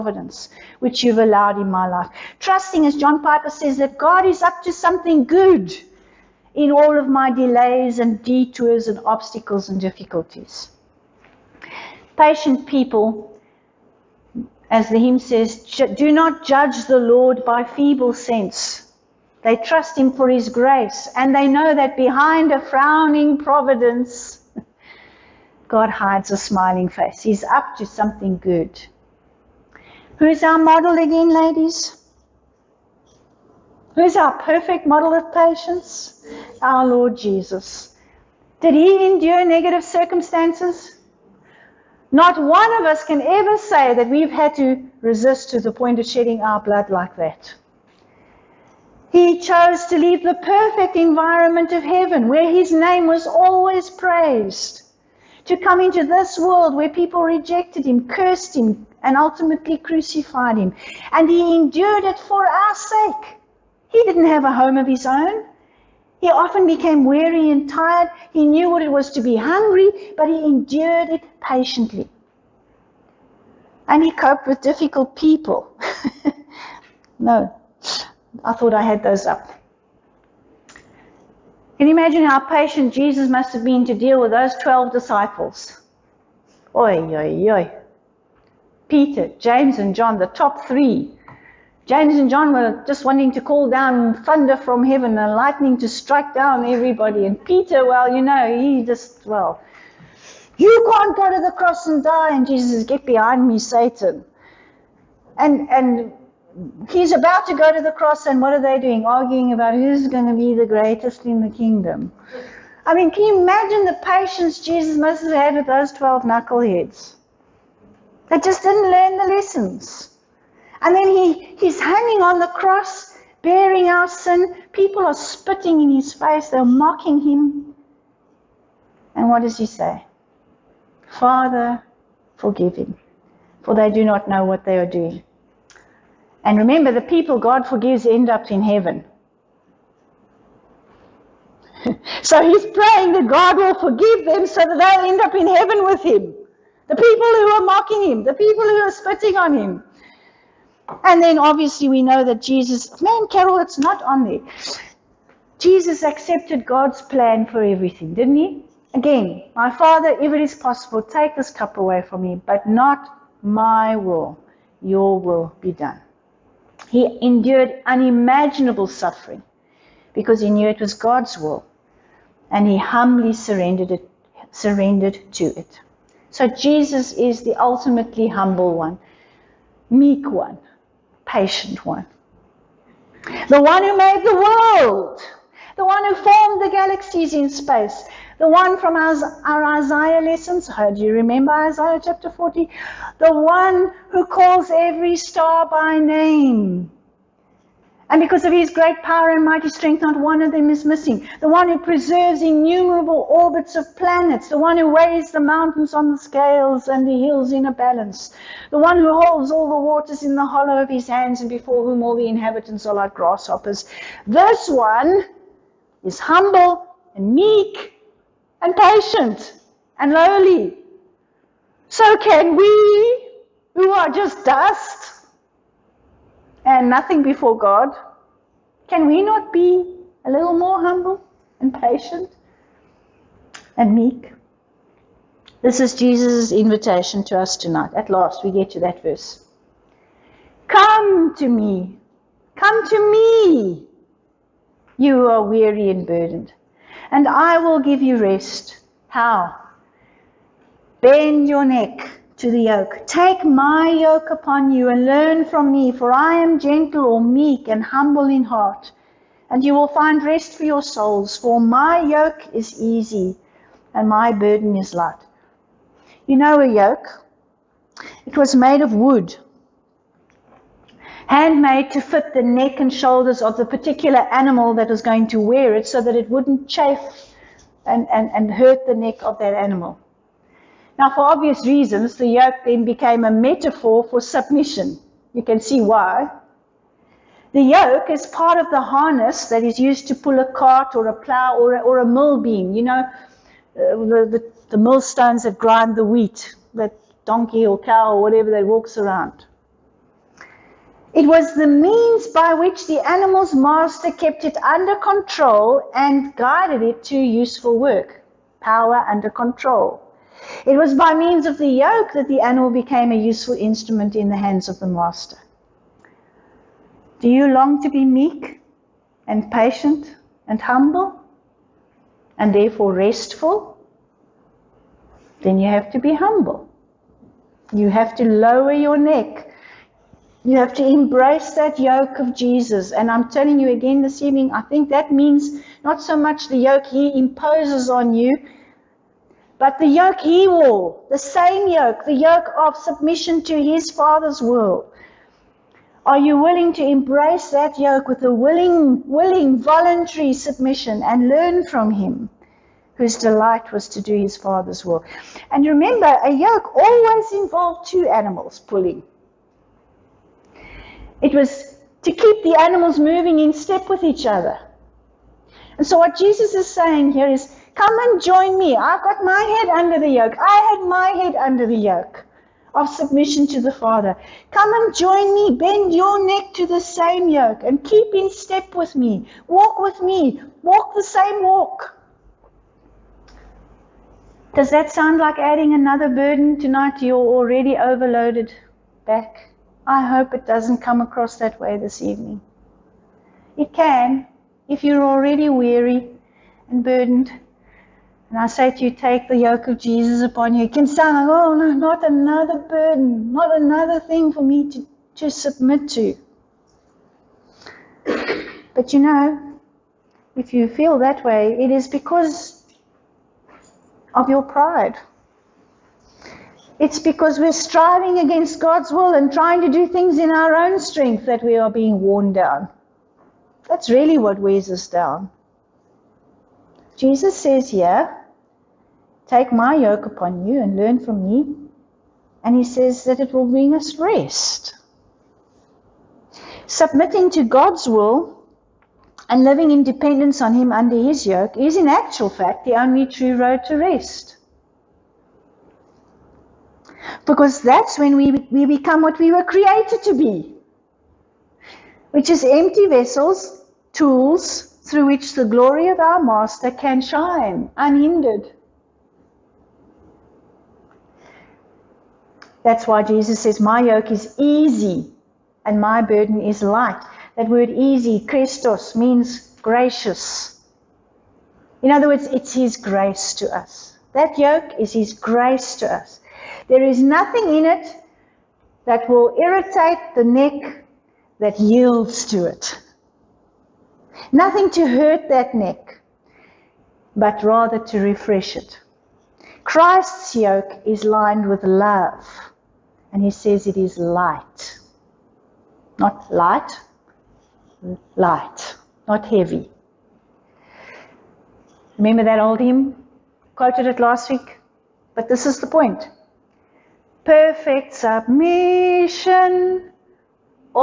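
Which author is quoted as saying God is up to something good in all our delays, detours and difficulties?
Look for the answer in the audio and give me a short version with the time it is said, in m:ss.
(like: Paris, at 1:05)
John Piper, at 0:02.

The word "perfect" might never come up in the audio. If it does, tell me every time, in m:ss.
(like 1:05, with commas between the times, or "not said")
0:34, 0:50, 8:27.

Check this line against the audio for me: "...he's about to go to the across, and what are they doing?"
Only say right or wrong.
wrong.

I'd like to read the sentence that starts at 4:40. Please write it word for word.
Now, for obvious reasons, the yoke then became a metaphor for submission.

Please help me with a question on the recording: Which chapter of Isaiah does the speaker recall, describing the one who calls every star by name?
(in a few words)
Isaiah chapter 40.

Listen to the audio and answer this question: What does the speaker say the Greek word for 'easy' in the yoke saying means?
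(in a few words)
gracious.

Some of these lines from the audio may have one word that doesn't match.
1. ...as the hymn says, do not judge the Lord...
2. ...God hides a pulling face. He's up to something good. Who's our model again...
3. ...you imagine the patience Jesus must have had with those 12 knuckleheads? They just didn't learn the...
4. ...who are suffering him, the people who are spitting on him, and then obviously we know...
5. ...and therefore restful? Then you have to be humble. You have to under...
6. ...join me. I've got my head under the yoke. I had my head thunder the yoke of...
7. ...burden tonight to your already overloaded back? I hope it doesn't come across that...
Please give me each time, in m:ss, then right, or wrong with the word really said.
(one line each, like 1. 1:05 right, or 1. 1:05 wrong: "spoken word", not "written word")
1. 0:14 right
2. 0:25 wrong: "smiling", not "pulling"
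3. 1:53 right
4. 2:27 wrong: "mocking", not "suffering"
5. 5:22 wrong: "lower", not "under"
6. 6:08 wrong: "under", not "thunder"
7. 6:26 right.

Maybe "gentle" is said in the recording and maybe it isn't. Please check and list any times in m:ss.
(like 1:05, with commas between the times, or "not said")
4:16.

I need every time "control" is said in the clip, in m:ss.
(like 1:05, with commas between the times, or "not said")
5:04, 5:09.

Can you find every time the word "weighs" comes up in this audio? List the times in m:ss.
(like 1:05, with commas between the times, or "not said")
3:24, 7:04.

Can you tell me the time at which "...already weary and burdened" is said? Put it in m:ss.
6:35.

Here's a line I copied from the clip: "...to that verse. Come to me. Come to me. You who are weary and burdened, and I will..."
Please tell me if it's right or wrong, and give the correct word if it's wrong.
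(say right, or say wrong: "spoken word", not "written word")
right.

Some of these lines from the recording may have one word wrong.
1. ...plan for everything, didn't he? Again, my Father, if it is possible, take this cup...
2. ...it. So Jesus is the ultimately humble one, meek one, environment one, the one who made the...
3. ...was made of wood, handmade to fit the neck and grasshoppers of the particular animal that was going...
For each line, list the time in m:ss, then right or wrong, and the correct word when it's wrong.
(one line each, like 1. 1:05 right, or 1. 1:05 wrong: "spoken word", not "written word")
1. 2:37 right
2. 2:55 wrong: "patient", not "environment"
3. 4:28 wrong: "shoulders", not "grasshoppers".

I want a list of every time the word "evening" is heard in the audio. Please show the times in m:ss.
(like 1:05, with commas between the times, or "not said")
5:34, 6:32.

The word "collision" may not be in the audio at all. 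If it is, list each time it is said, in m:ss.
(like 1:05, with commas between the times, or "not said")
not said.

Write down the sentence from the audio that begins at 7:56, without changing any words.
There is nothing in it that will irritate the neck that yields to it.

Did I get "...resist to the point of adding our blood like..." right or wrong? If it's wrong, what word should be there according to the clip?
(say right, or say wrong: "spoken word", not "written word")
wrong: "shedding", not "adding".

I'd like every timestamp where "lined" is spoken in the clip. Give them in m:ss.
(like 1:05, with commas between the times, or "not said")
8:11.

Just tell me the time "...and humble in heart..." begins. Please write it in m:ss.
4:17.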